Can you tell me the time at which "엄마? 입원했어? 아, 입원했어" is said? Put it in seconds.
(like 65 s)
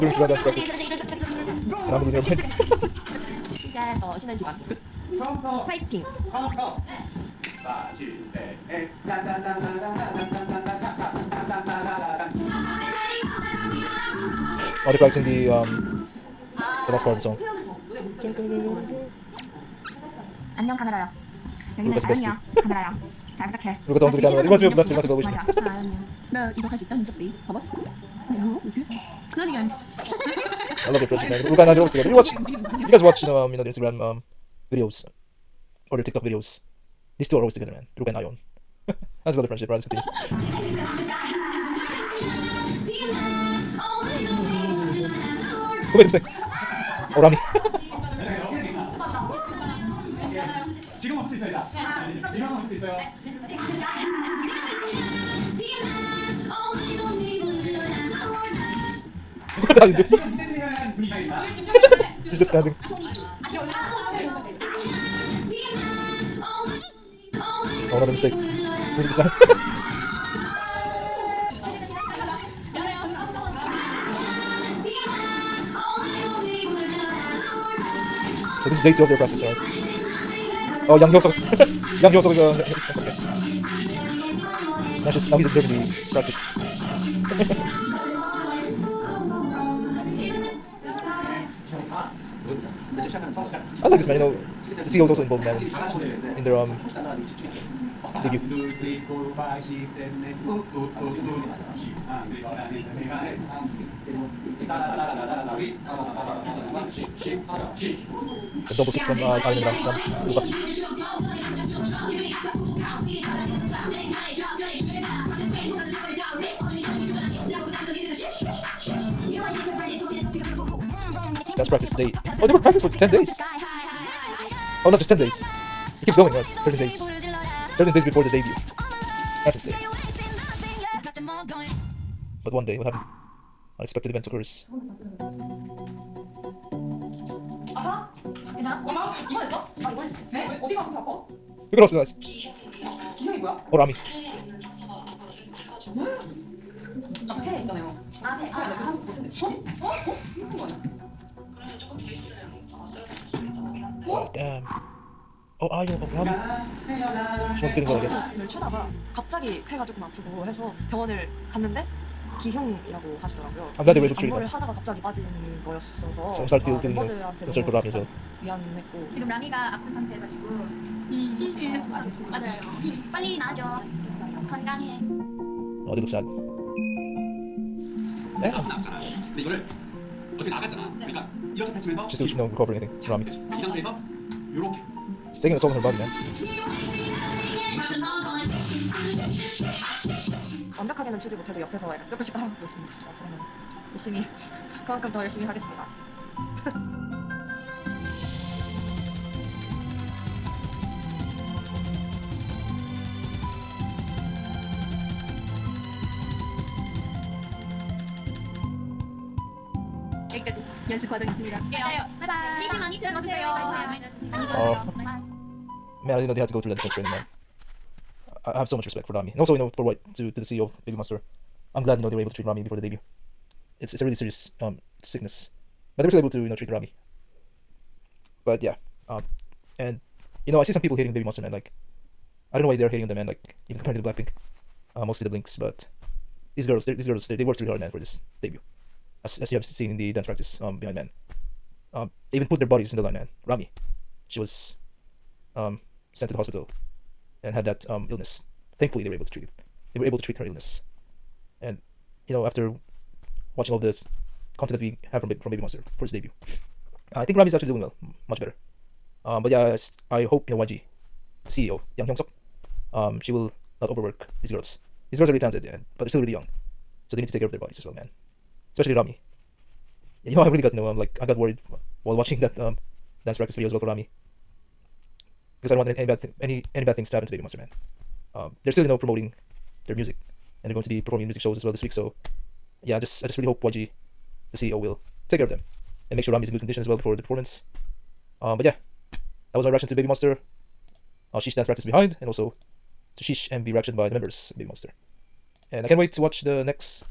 138 s.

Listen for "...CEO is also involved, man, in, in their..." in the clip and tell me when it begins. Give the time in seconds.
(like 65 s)
94 s.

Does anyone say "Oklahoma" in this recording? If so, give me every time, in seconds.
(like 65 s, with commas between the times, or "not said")
156 s.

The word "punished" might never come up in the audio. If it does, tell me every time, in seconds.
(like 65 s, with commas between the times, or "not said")
not said.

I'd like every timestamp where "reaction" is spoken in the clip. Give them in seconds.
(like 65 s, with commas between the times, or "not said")
289 s, 293 s.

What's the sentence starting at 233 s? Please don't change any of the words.
Like, even comparing to the Blackpink.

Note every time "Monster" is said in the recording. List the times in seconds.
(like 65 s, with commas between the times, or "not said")
220 s, 231 s, 255 s, 277 s, 290 s, 294 s.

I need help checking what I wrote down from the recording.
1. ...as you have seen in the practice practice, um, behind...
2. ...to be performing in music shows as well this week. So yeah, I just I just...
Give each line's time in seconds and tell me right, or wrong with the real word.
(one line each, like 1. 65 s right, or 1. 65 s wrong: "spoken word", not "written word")
1. 239 s wrong: "dance", not "practice"
2. 280 s right.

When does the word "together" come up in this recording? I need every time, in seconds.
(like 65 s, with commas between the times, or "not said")
31 s, 37 s.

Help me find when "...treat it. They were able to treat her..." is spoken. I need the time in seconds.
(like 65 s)
249 s.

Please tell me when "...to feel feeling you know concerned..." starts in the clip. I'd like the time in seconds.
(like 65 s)
166 s.